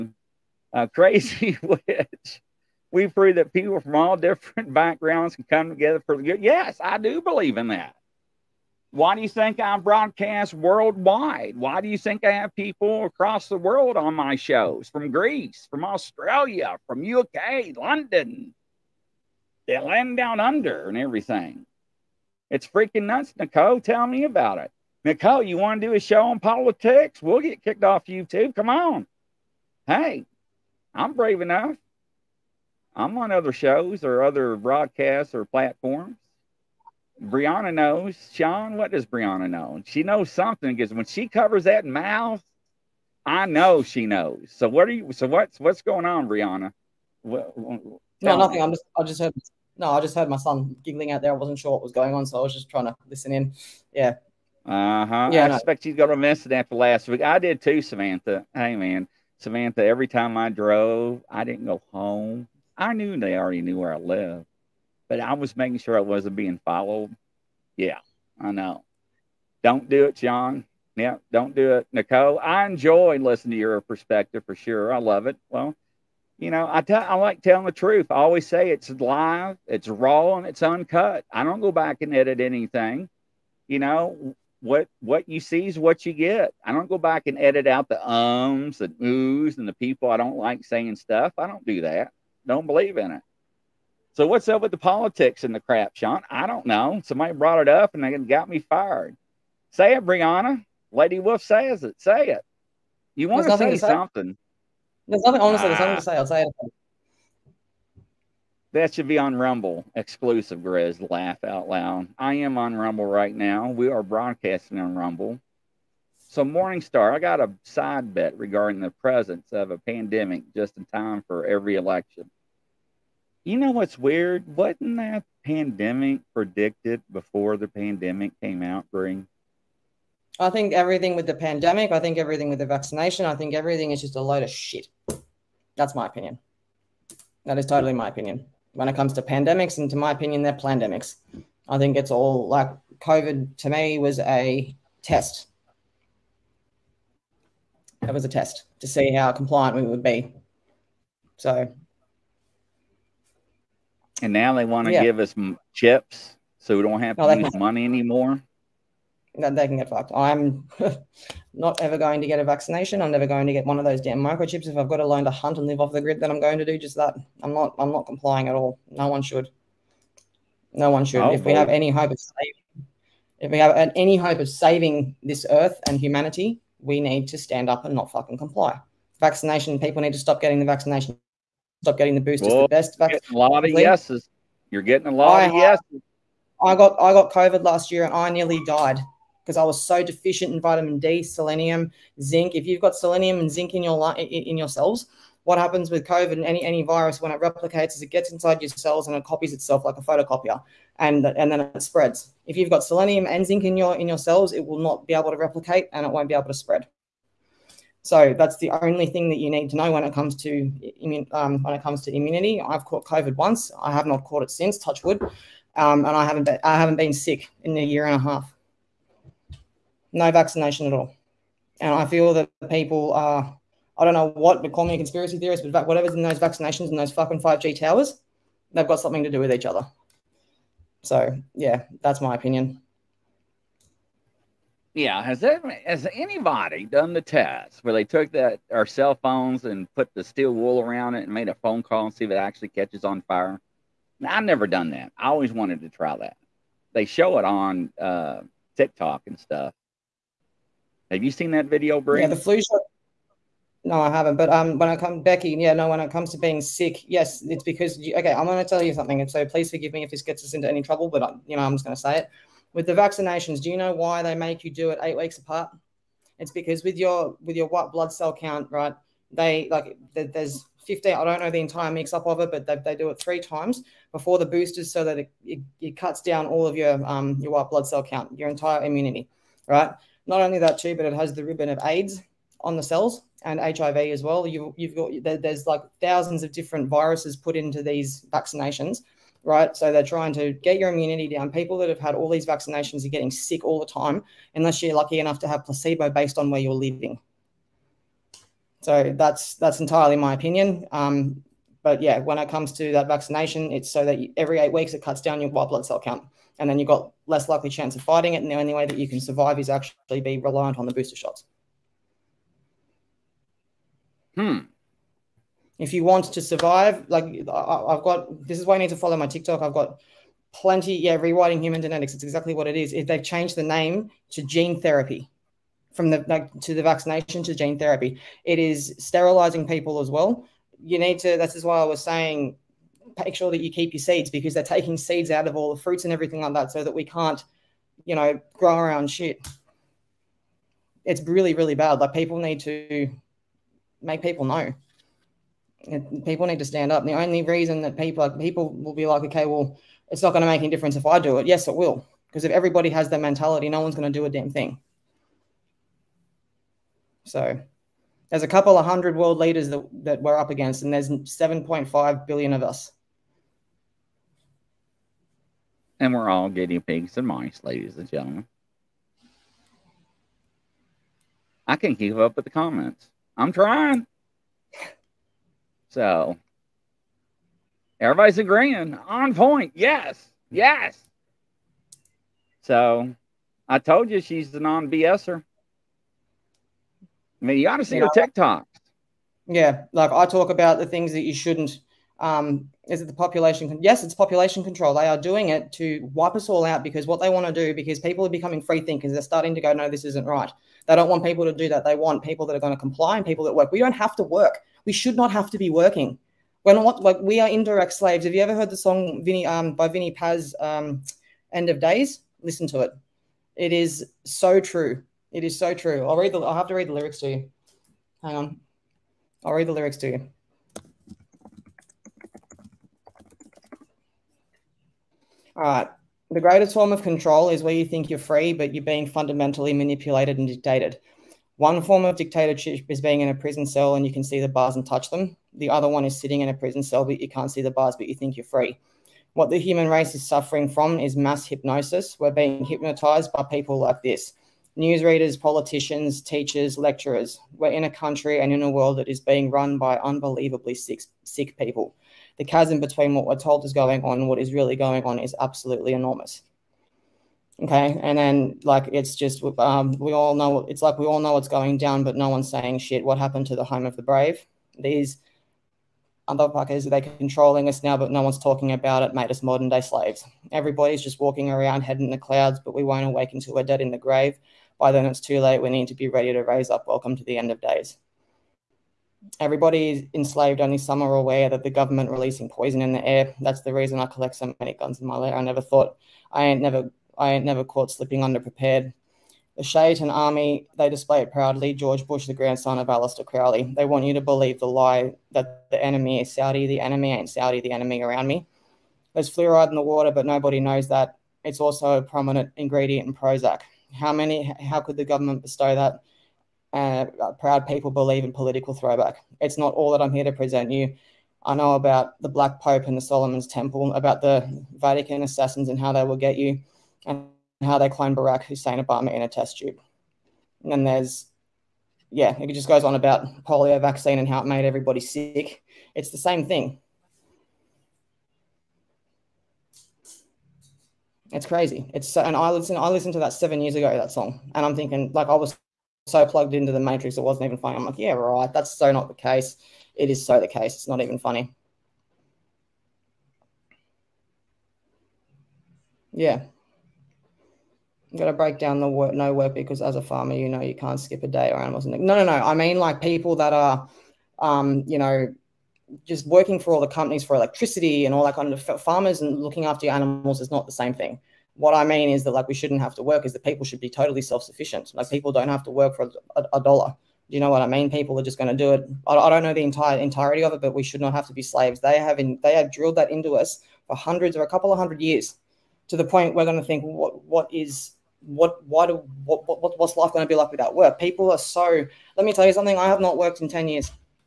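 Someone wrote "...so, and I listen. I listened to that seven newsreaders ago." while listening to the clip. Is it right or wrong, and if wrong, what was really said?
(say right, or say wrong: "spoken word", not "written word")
wrong: "years", not "newsreaders".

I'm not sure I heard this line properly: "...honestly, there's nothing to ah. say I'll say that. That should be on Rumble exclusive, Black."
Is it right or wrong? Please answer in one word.
wrong.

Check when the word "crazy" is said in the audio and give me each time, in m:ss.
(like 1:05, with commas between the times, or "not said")
0:00, 8:51.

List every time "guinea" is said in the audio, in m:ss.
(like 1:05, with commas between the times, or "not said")
6:06.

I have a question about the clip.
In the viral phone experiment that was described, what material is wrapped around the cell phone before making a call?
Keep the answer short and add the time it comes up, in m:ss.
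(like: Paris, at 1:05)
Steel wool, at 4:00.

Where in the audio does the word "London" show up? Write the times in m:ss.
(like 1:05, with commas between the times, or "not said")
0:17.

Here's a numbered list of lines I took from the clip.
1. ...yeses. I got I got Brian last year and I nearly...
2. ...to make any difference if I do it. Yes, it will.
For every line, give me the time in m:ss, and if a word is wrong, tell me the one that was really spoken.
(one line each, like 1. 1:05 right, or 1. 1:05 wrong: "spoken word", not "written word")
1. 3:05 wrong: "COVID", not "Brian"
2. 5:50 right.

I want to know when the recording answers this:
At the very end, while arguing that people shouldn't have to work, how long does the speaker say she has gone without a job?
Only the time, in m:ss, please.
9:43.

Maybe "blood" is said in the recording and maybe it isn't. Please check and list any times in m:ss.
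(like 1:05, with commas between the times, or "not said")
4:27, 4:37, 5:05.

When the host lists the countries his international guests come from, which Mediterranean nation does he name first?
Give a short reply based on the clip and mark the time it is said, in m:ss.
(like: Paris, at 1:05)
Greece, at 0:15.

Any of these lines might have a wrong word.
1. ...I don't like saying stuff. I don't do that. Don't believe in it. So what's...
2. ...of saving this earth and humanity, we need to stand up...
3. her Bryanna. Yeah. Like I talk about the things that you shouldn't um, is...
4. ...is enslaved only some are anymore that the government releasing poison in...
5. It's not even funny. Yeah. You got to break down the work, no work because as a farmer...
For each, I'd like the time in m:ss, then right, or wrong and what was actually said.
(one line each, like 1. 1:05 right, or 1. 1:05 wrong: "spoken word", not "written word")
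1. 1:30 right
2. 2:54 right
3. 6:28 wrong: "TikToks", not "Bryanna"
4. 7:59 wrong: "aware", not "anymore"
5. 9:00 right.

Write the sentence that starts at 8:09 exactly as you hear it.
The Shaitan Army, they display it proudly.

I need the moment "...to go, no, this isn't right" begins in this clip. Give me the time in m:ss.
6:39.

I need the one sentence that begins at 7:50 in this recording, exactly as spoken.
Everybody's just walking around head in the clouds, but we won't awake until we're dead in the grave.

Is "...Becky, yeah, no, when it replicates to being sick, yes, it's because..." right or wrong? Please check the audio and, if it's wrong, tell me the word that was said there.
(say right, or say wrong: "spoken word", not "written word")
wrong: "comes", not "replicates".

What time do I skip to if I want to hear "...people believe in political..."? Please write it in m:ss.
8:27.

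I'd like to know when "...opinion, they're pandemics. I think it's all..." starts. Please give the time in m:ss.
2:20.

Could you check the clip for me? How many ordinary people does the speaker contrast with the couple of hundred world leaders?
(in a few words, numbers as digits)
7.5 billion.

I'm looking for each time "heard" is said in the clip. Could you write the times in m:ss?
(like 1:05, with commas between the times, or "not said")
0:50, 6:48.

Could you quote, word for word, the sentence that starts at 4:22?
With the vaccinations, do you know why they make you do it eight weeks apart?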